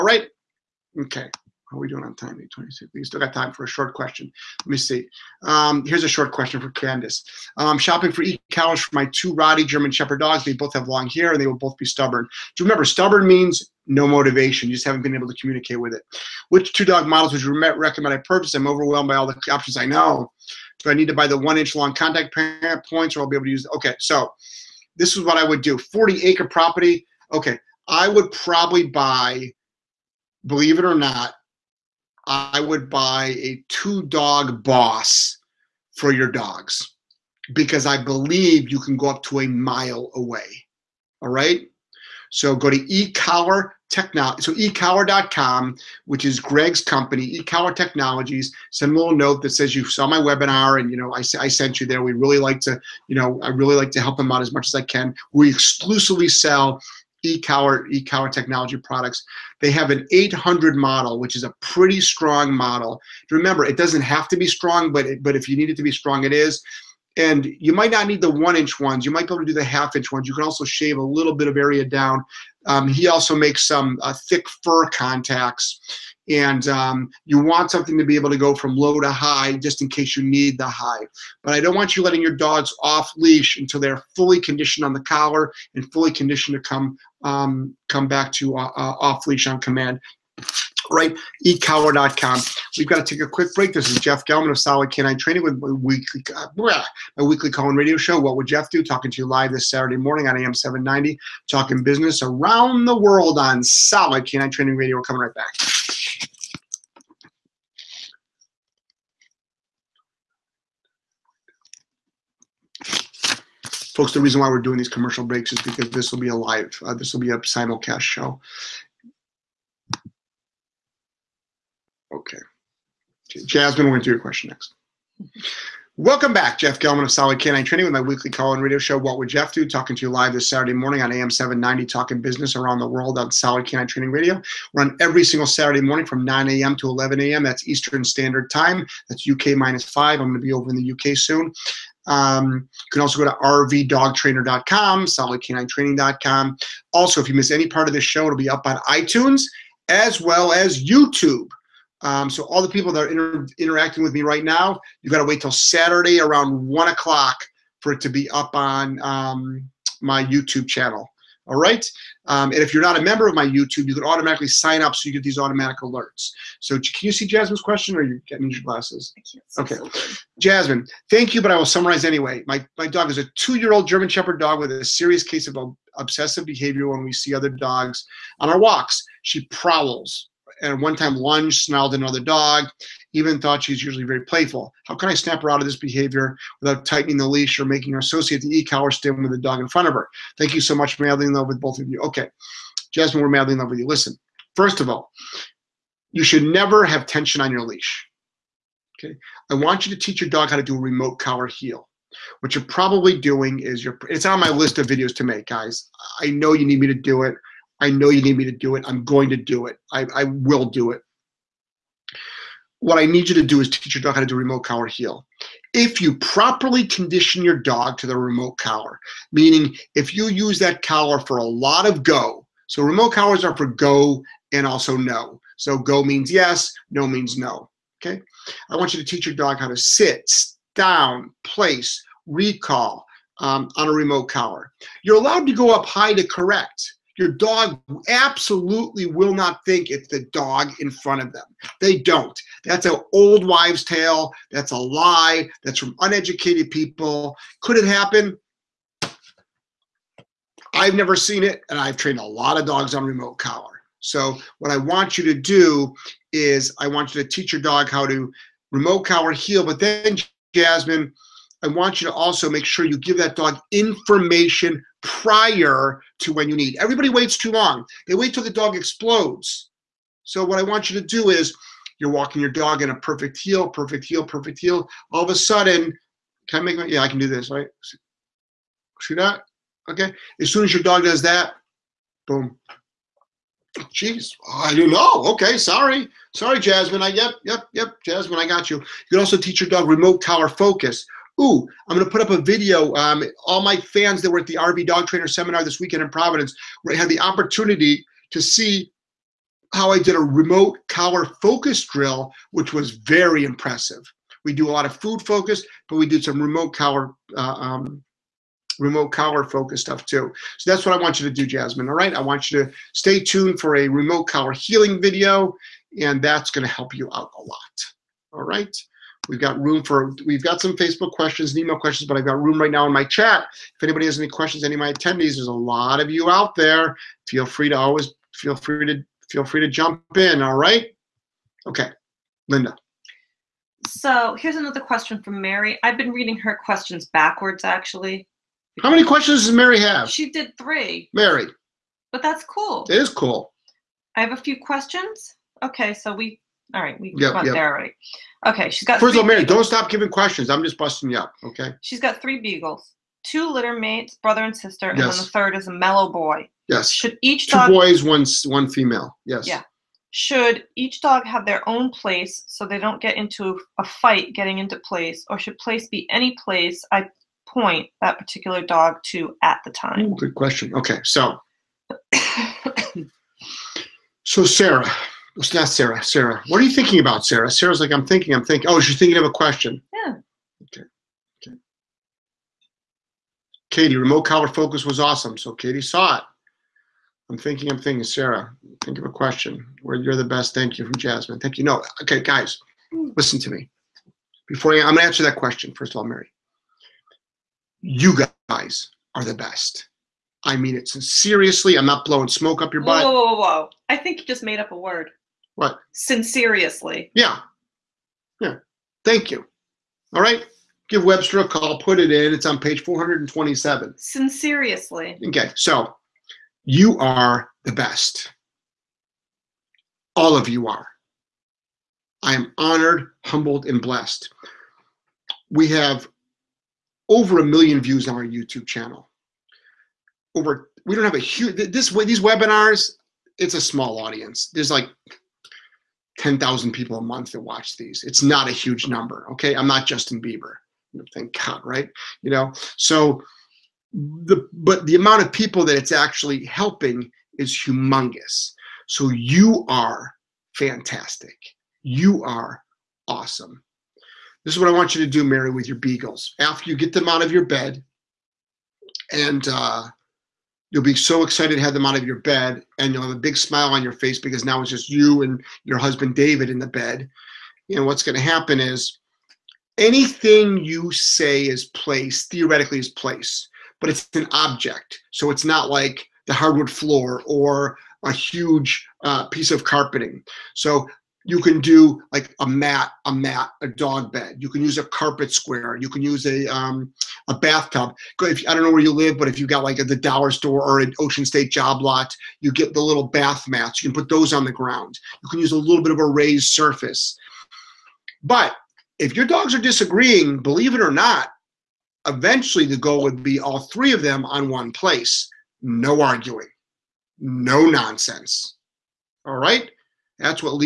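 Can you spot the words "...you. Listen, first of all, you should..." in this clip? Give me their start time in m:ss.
3:13.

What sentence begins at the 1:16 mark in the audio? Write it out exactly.
And um, you want something to be able to go from low to high just in case you need the high.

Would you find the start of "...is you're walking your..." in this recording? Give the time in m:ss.
4:31.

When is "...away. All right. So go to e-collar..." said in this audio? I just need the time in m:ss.
0:40.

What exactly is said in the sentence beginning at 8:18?
But if your dogs are disagreeing, believe it or not, eventually the goal would be all three of them on one place.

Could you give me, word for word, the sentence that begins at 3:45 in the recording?
So go means yes, no means no.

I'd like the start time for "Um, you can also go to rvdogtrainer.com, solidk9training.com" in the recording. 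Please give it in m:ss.
2:22.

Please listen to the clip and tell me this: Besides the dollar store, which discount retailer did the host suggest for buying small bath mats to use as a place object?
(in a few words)
Ocean State Job Lot.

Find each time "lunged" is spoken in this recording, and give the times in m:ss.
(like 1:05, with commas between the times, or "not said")
3:01.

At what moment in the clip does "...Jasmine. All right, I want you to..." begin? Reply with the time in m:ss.
5:11.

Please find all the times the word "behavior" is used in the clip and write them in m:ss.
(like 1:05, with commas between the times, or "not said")
2:56, 3:05.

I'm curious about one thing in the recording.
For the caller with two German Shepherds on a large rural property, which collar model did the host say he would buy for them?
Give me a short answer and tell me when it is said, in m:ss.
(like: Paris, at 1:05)
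two dog boss, at 0:33.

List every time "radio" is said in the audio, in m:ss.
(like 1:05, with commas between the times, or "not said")
1:37, 1:44, 2:08, 2:14.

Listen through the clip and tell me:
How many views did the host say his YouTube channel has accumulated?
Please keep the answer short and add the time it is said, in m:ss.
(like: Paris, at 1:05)
over a million, at 7:07.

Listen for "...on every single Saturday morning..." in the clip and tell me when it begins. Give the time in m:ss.
2:14.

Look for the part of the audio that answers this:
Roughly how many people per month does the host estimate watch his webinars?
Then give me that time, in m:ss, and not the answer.
7:16.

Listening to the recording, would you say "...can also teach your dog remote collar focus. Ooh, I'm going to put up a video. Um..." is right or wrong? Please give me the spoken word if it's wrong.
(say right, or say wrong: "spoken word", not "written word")
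right.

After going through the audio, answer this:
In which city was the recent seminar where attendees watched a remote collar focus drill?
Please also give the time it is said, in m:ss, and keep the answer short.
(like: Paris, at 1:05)
Providence, at 4:56.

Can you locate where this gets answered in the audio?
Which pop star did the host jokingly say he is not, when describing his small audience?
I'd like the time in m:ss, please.
7:19.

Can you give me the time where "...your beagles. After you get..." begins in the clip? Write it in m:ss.
7:35.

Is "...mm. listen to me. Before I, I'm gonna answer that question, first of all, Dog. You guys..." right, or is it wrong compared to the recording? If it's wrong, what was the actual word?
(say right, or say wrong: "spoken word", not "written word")
wrong: "Mary", not "Dog".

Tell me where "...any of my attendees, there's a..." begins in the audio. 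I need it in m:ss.
5:24.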